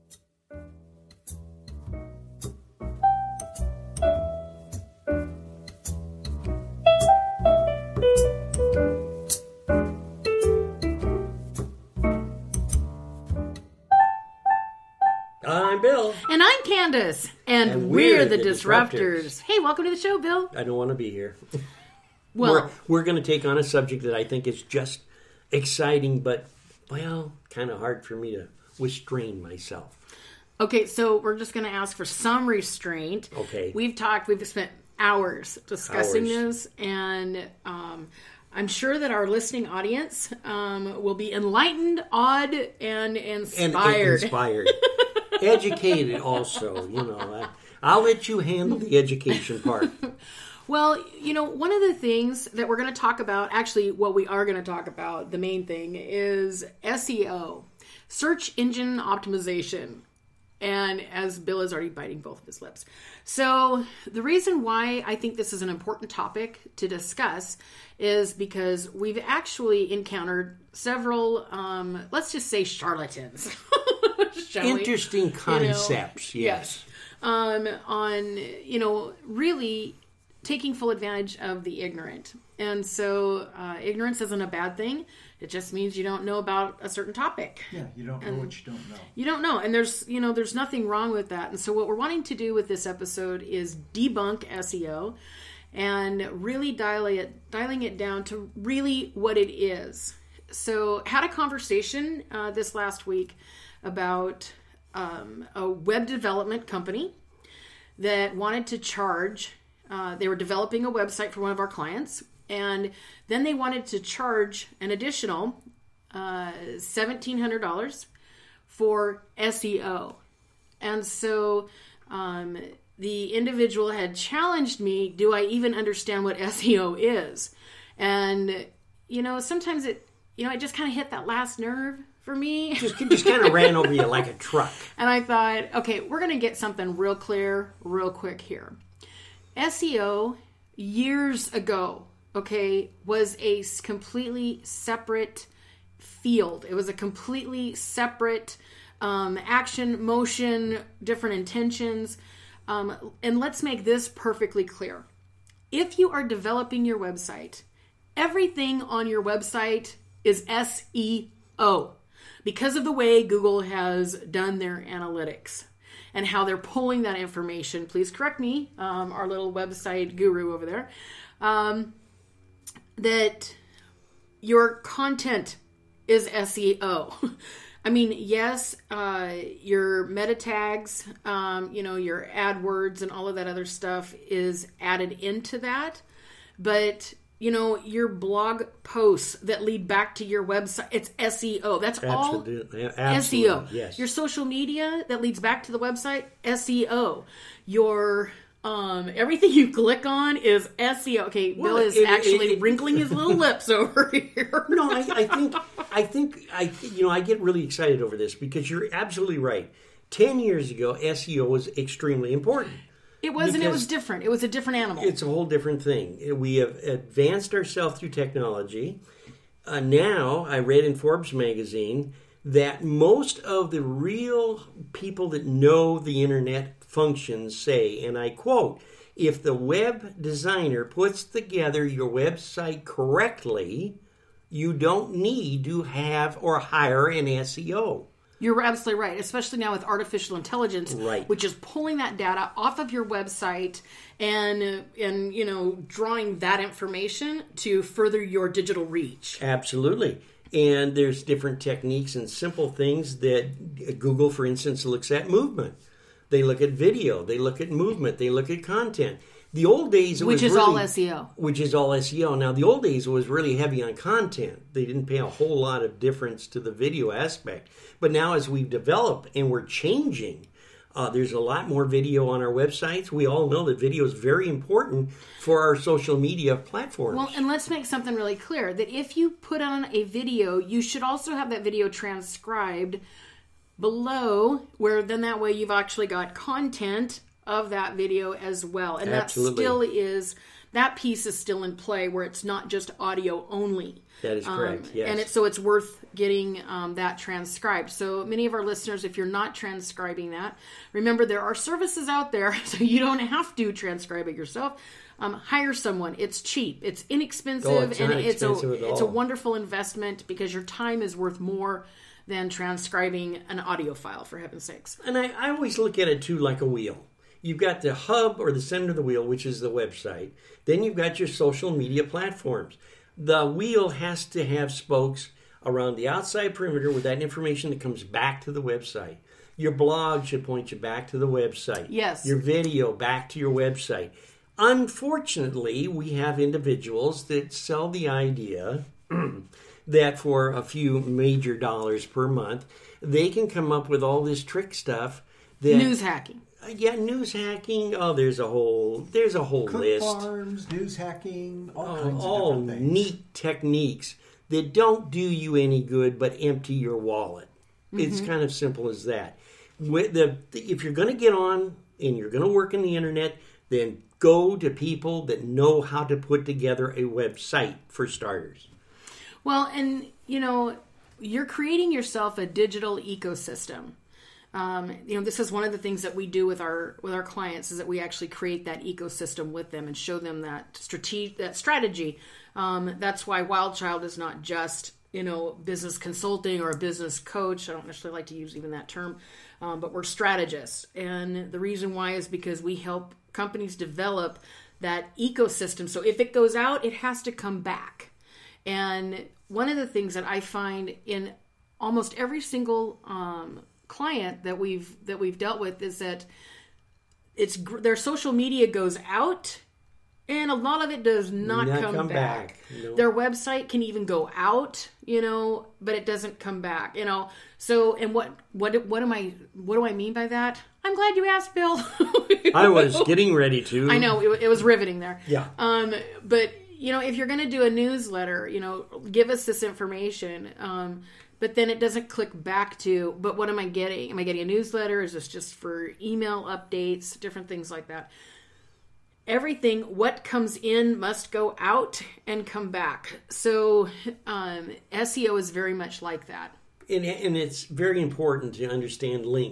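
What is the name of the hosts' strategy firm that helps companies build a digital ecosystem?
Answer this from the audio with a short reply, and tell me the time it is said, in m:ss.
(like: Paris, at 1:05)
Wild Child, at 6:23.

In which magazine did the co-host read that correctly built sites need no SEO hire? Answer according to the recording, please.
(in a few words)
Forbes.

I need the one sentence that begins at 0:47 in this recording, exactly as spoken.
I, I'll let you handle the education part.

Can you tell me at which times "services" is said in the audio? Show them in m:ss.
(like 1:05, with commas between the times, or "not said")
5:01.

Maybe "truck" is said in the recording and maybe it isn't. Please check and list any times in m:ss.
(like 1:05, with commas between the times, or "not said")
2:14.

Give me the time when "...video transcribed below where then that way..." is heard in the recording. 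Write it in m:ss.
4:41.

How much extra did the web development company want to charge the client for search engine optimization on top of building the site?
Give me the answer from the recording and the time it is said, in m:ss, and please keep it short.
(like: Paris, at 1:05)
$1,700, at 1:56.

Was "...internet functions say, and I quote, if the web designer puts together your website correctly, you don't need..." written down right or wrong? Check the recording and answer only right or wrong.
right.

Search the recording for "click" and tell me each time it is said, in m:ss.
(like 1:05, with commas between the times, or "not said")
3:19, 7:12.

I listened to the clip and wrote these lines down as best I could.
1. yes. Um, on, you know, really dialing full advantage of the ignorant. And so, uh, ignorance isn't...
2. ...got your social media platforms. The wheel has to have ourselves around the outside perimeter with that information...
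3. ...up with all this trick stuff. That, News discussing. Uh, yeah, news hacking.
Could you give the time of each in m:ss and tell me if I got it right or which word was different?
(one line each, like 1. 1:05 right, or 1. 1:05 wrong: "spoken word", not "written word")
1. 1:16 wrong: "taking", not "dialing"
2. 5:20 wrong: "spokes", not "ourselves"
3. 5:43 wrong: "hacking", not "discussing".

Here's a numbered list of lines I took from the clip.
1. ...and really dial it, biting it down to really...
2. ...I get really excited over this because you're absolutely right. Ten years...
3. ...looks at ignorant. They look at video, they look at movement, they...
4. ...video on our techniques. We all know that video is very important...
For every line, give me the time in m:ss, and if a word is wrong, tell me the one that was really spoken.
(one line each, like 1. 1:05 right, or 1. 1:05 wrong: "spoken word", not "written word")
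1. 1:35 wrong: "dialing", not "biting"
2. 3:27 right
3. 4:14 wrong: "movement", not "ignorant"
4. 4:31 wrong: "websites", not "techniques".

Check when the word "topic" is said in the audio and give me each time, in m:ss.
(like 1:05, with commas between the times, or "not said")
1:06, 1:27.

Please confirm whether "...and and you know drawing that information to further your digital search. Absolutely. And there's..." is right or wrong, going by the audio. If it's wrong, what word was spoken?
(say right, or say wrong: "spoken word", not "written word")
wrong: "reach", not "search".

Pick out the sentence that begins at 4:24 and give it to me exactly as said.
They didn't pay a whole lot of difference to the video aspect.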